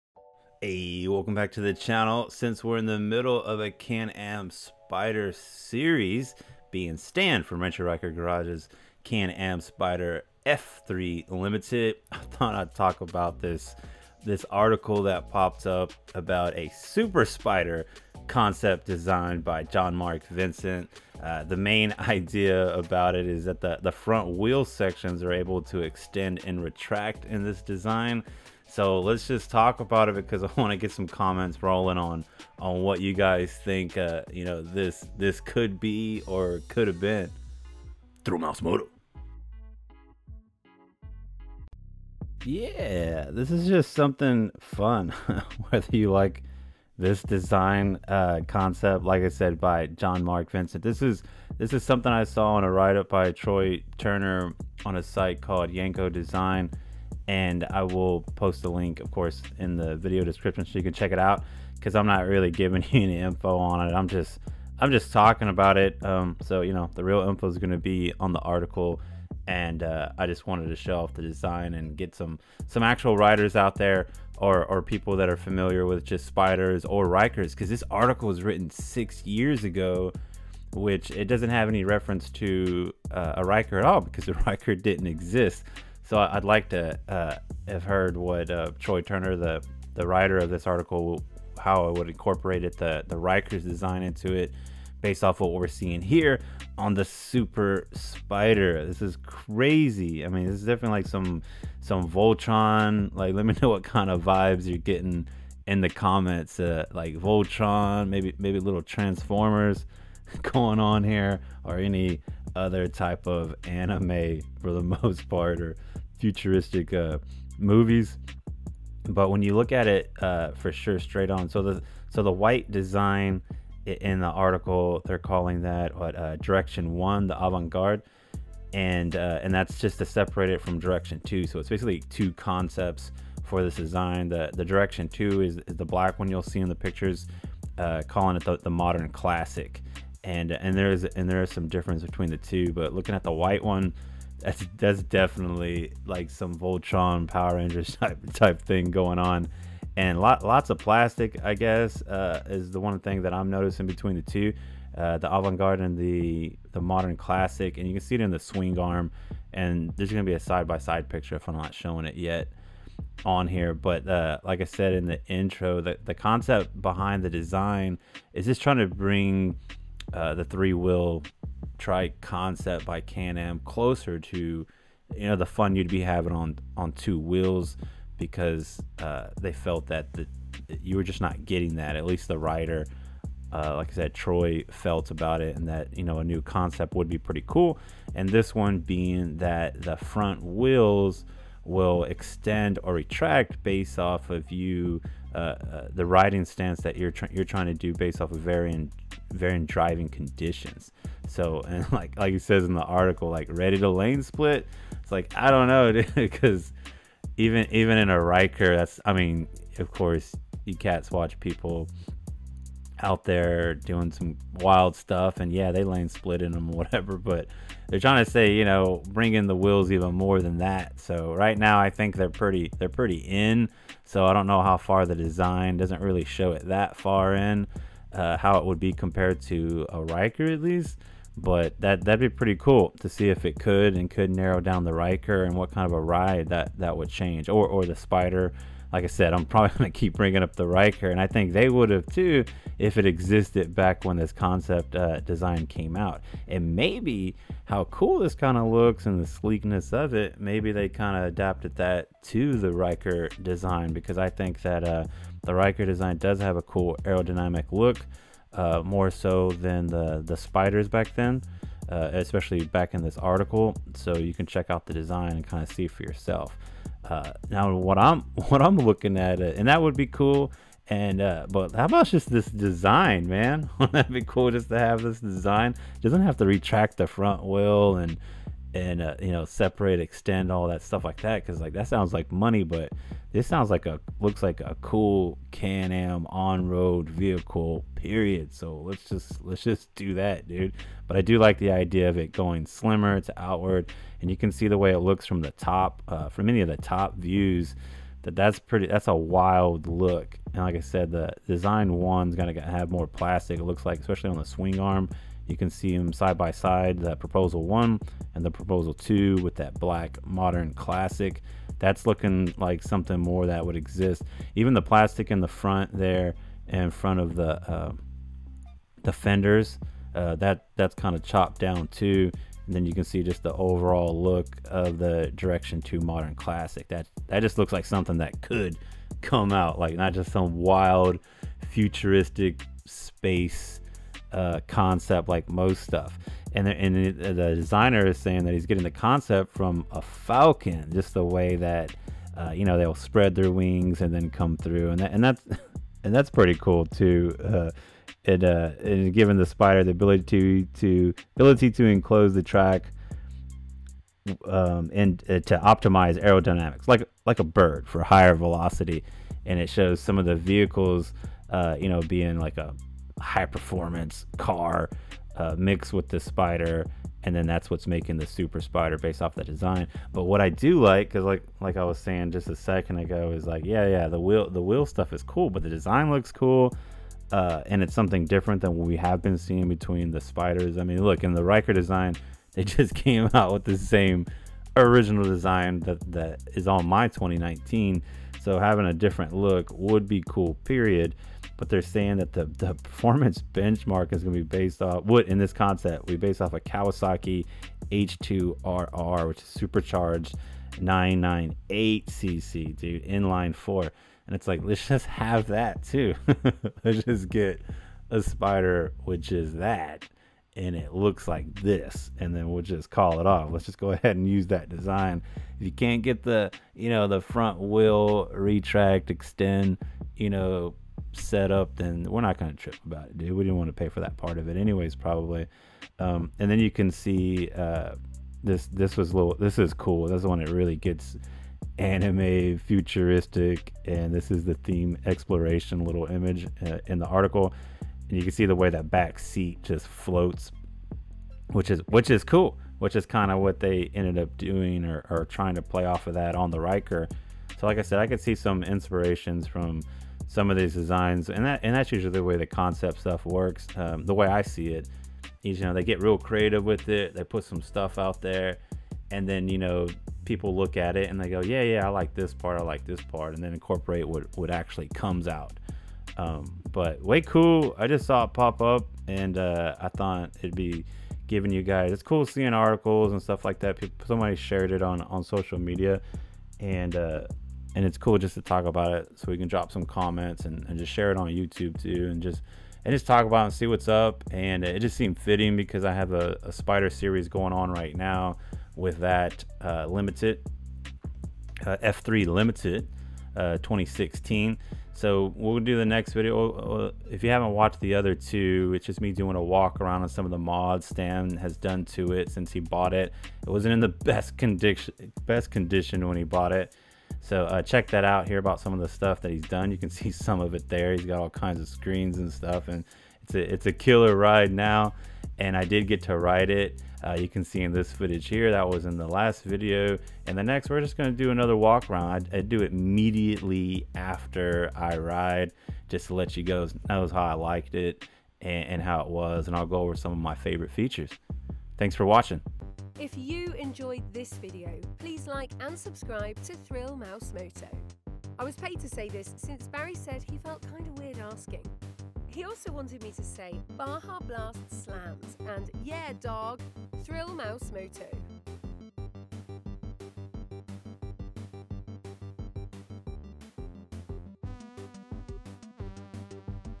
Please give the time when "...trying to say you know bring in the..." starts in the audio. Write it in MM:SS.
03:37.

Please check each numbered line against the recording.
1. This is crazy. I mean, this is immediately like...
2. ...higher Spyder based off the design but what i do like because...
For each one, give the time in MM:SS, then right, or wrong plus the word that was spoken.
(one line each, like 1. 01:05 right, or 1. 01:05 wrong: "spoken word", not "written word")
1. 01:38 wrong: "definitely", not "immediately"
2. 06:08 wrong: "super", not "higher".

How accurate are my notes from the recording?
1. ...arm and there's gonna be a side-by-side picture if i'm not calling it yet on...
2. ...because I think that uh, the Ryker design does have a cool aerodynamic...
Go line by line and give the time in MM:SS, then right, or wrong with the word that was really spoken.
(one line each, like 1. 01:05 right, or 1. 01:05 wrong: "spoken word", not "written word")
1. 02:38 wrong: "showing", not "calling"
2. 04:13 right.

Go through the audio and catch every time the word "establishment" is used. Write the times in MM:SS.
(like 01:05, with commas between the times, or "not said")
not said.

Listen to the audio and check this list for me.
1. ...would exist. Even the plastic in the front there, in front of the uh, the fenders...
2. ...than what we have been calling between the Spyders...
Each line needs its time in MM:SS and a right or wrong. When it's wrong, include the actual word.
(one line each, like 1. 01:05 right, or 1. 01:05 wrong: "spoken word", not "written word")
1. 05:13 right
2. 06:18 wrong: "seeing", not "calling".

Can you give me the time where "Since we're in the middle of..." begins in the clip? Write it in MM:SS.
00:02.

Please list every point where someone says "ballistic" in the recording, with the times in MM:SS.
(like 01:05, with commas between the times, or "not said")
not said.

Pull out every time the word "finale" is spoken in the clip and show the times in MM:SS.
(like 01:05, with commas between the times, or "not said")
not said.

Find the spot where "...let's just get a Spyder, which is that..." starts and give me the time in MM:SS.
06:46.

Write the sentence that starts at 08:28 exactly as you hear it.
Hear about some of the stuff that he's done.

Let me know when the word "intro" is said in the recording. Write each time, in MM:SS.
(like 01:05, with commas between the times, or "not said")
02:45.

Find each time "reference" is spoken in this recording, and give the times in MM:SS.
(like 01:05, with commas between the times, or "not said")
01:21.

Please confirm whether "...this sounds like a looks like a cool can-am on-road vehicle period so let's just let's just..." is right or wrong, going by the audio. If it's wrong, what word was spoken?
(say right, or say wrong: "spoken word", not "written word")
right.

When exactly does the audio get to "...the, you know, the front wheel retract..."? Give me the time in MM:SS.
06:56.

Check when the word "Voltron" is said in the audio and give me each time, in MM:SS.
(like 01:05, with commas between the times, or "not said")
01:42, 01:47, 02:26.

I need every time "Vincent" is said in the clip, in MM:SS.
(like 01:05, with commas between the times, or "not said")
00:20, 00:50.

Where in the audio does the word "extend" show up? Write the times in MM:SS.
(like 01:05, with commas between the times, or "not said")
00:25, 03:12, 04:39, 06:59.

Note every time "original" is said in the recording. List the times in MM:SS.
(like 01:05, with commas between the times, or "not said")
06:24.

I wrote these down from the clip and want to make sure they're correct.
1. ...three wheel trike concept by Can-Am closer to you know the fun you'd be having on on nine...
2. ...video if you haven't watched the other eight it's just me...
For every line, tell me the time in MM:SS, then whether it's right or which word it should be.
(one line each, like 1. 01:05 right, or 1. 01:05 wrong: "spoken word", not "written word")
1. 02:50 wrong: "two", not "nine"
2. 08:16 wrong: "two", not "eight".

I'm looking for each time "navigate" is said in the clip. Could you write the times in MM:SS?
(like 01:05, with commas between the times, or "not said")
not said.